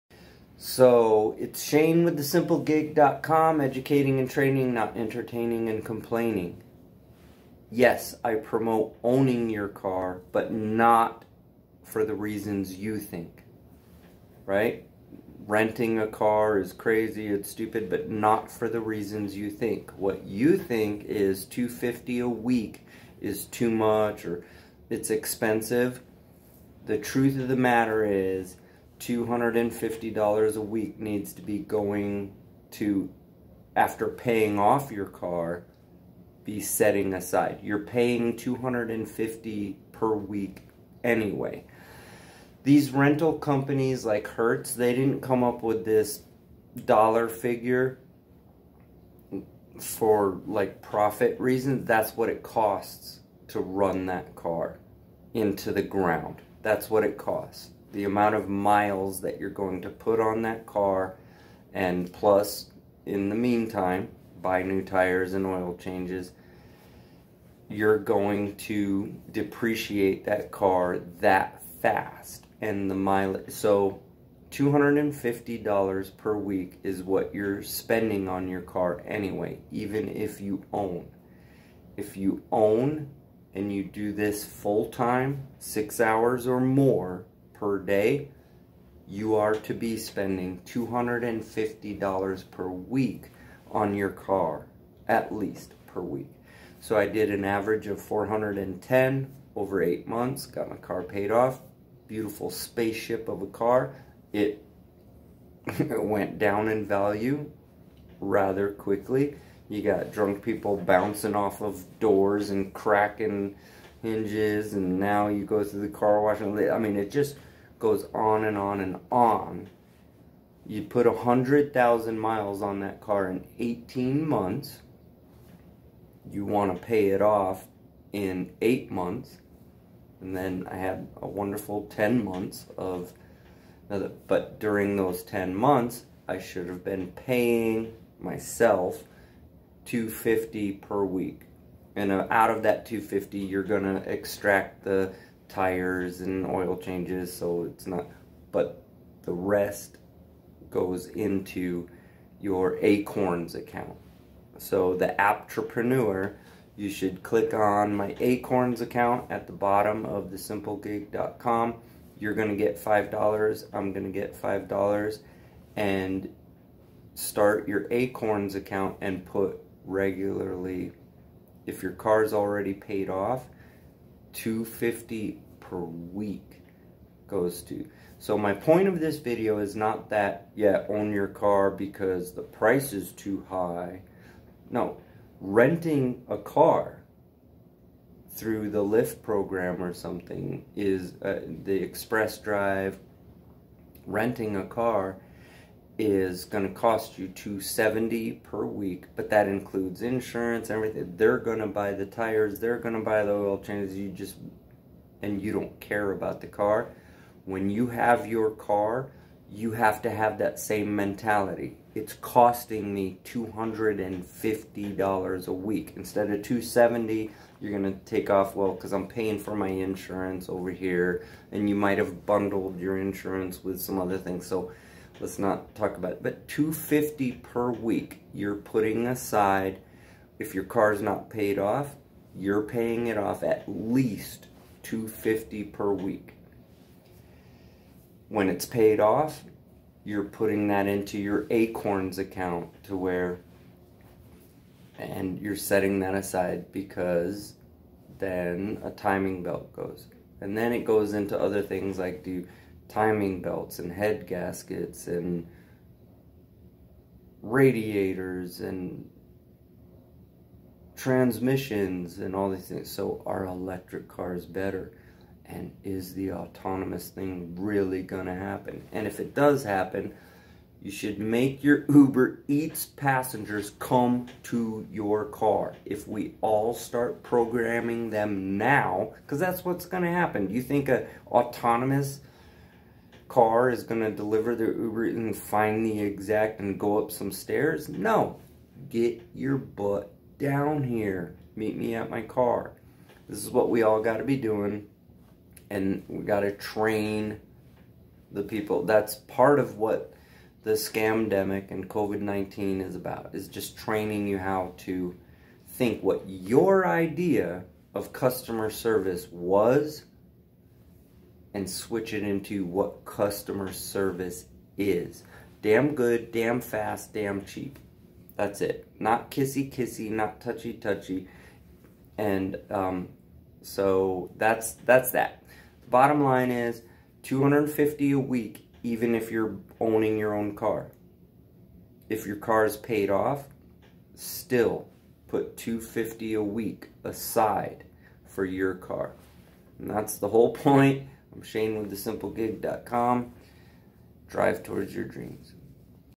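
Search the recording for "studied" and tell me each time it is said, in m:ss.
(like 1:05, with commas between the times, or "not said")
not said.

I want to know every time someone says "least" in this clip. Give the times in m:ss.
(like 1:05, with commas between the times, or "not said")
1:35, 3:53.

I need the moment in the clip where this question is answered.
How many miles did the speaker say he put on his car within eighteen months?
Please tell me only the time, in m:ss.
2:01.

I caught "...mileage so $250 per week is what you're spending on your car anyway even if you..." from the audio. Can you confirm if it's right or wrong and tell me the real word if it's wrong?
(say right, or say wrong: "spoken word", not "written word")
right.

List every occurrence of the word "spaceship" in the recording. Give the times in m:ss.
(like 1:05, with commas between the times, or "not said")
1:42.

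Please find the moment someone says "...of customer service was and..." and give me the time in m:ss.
5:07.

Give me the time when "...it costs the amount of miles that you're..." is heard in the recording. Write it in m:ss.
0:57.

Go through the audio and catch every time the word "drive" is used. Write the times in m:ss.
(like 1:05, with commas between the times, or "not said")
3:12, 5:44.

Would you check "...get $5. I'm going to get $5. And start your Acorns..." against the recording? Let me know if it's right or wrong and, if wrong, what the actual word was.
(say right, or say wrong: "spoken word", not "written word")
right.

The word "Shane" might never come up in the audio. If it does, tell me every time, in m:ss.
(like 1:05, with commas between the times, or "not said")
0:01, 5:41.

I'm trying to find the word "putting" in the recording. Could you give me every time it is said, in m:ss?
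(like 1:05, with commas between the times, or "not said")
3:48, 4:00.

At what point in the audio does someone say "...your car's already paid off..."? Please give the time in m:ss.
2:51.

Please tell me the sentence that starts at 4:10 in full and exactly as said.
And then it goes into other things like do timing belts and head gaskets and radiators and transmissions and all these things.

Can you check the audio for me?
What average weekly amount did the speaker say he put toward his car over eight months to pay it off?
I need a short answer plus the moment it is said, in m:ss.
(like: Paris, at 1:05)
410, at 1:38.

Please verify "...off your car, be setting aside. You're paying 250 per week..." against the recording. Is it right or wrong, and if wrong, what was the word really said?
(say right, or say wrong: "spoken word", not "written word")
right.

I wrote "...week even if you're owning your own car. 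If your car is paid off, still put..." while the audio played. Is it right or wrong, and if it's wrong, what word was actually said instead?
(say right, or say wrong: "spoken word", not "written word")
right.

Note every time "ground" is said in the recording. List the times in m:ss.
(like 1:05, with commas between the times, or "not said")
0:55.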